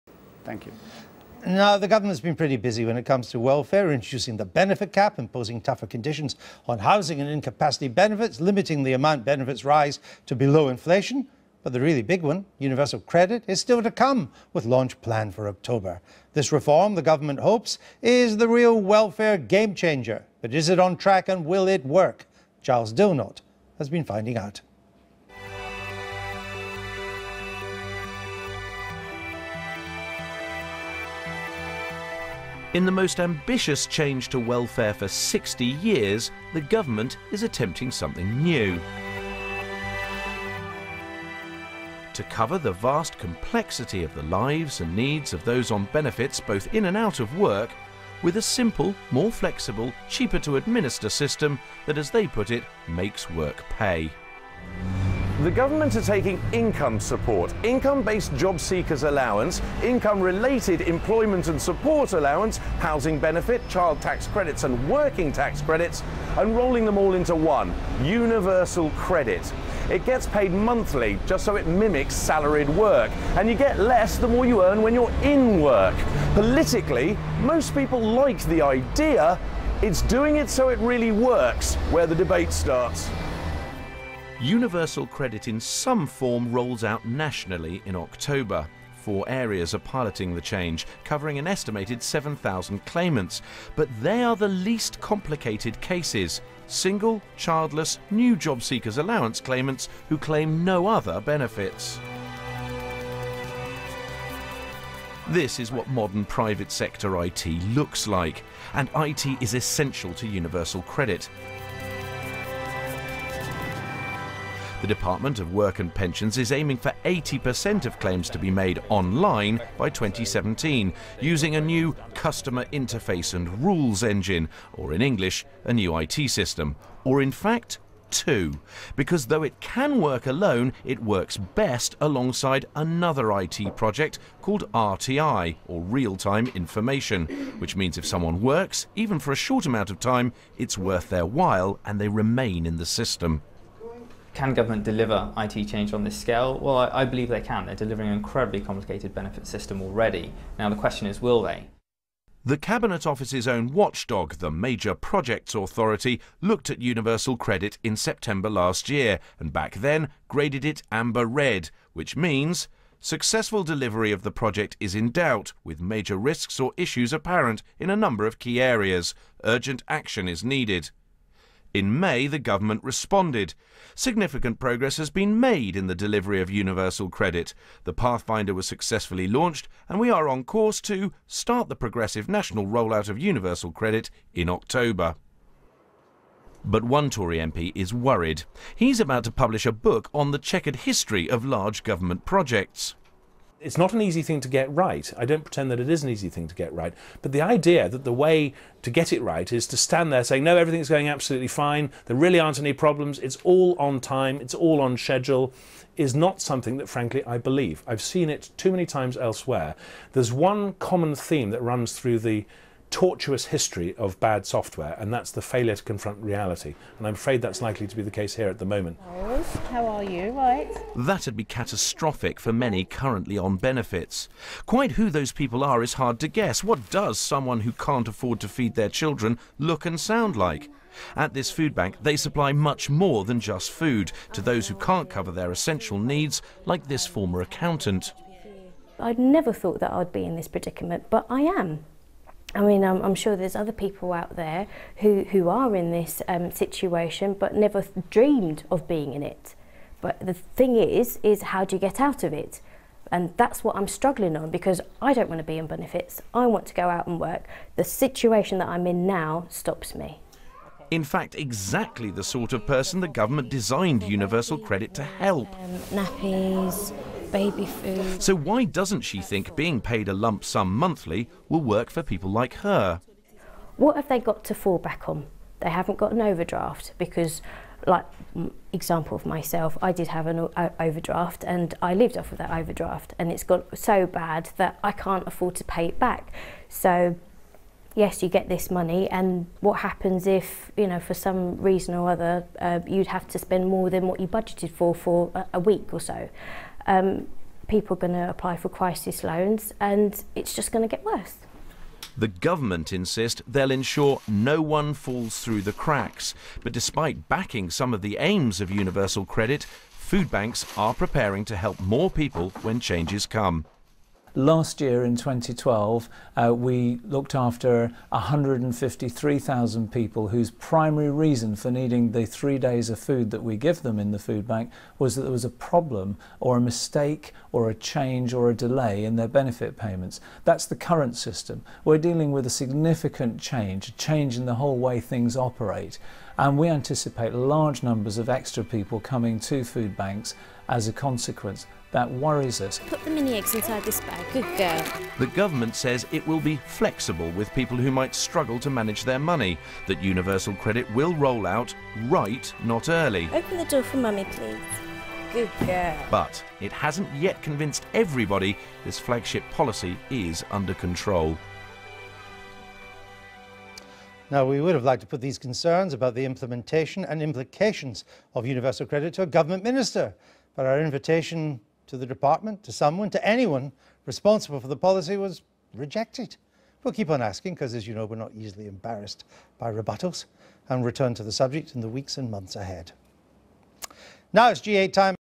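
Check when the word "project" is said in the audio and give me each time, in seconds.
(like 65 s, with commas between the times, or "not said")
133 s, 154 s, 164 s, 192 s.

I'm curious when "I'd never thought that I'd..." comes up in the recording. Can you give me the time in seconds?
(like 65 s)
238 s.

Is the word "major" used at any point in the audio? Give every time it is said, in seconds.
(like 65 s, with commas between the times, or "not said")
154 s, 165 s.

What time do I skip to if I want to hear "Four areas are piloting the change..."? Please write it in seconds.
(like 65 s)
89 s.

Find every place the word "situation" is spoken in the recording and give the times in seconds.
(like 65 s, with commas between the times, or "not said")
246 s, 257 s.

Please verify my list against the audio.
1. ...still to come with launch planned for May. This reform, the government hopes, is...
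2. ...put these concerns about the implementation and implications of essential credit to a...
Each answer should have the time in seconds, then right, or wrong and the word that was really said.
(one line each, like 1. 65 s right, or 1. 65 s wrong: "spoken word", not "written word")
1. 13 s wrong: "October", not "May"
2. 365 s wrong: "universal", not "essential".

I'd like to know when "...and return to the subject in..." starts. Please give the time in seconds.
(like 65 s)
380 s.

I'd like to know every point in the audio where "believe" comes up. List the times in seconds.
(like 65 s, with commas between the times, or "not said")
147 s, 207 s.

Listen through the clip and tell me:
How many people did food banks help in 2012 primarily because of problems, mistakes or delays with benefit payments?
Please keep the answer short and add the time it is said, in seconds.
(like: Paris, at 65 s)
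153,000, at 318 s.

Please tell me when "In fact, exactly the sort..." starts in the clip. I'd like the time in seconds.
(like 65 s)
260 s.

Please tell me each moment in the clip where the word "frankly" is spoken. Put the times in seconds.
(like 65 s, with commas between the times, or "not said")
206 s.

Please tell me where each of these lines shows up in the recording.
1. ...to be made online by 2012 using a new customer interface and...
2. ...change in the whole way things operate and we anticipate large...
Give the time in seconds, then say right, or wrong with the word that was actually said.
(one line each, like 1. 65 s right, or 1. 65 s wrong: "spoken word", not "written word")
1. 118 s wrong: "2017", not "2012"
2. 333 s right.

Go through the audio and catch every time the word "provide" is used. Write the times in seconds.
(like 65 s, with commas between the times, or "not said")
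not said.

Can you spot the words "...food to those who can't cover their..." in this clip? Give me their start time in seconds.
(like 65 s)
233 s.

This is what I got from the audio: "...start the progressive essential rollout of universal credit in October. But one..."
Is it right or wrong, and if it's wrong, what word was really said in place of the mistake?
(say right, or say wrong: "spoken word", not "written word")
wrong: "national", not "essential".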